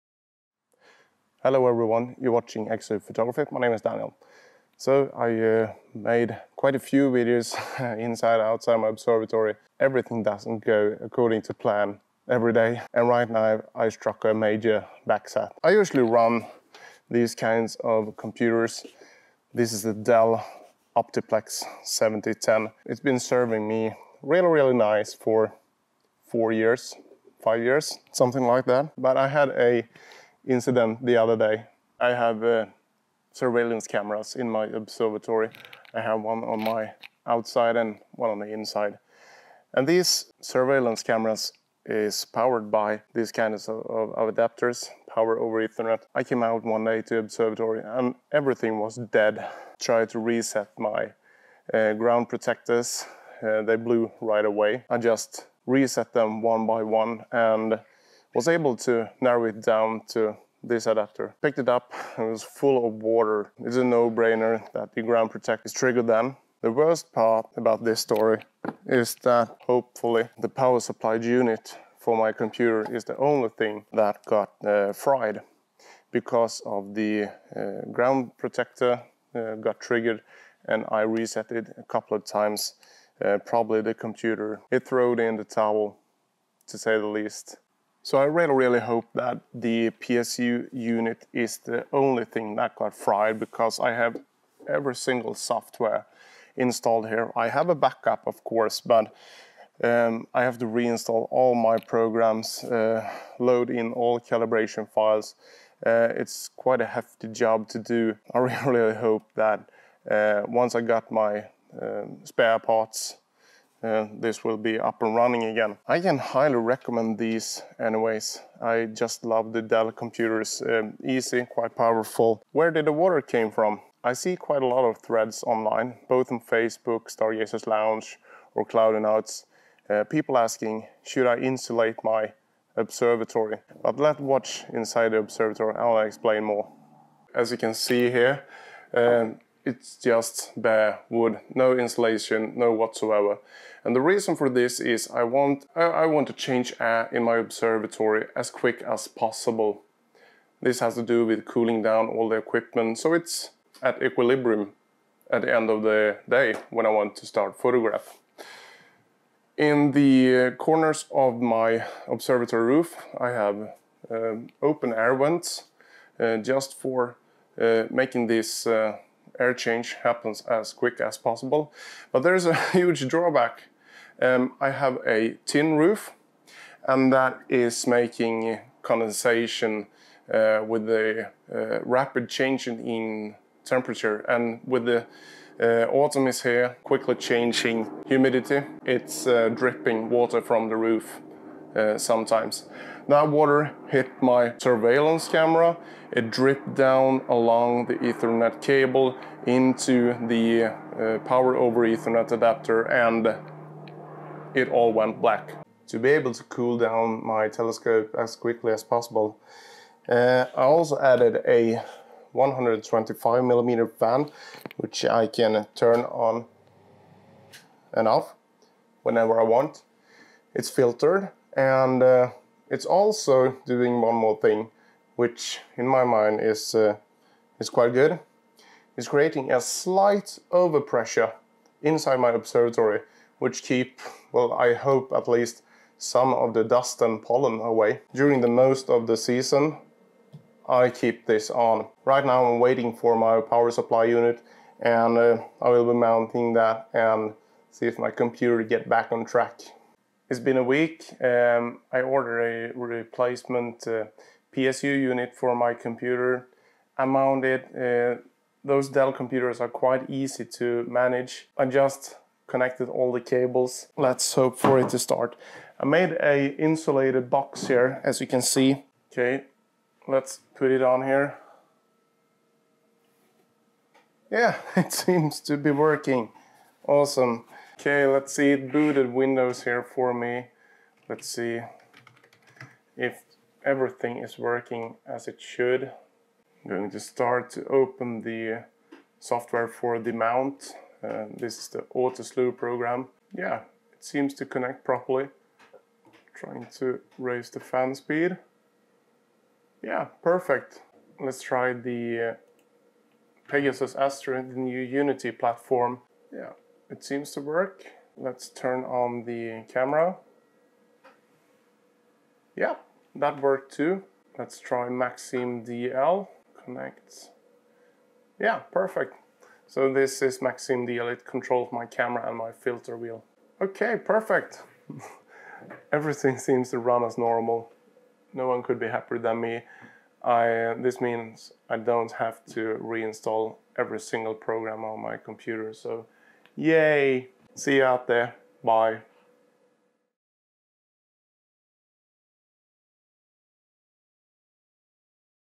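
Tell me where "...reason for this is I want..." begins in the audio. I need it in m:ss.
2:24.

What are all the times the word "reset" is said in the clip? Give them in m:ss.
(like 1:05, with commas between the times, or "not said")
0:50, 0:55, 1:21.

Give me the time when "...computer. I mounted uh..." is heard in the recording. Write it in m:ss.
4:15.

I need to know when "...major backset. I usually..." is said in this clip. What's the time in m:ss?
0:14.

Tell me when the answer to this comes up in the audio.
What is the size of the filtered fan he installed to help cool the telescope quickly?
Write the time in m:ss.
3:32.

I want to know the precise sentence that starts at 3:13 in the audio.
That water hit my surveillance camera.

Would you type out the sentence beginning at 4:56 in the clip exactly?
Trying to raise the fan speed.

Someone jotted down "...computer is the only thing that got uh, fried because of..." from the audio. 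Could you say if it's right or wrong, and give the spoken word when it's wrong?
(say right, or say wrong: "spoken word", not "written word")
right.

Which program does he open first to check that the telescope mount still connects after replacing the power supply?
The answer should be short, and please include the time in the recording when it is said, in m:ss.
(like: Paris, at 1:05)
AutoSlew, at 4:51.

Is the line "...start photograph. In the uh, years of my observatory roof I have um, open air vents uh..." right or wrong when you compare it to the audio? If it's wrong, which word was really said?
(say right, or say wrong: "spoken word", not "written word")
wrong: "corners", not "years".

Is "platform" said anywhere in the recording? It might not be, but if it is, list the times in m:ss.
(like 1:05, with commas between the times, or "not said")
5:05.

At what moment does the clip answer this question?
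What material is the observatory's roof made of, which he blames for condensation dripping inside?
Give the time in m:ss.
2:55.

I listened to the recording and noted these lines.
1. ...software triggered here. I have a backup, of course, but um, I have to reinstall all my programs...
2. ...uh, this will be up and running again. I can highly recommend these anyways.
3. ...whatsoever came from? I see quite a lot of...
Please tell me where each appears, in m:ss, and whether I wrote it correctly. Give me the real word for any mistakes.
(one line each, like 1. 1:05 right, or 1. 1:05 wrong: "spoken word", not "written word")
1. 1:35 wrong: "installed", not "triggered"
2. 1:53 right
3. 2:02 wrong: "water", not "whatsoever".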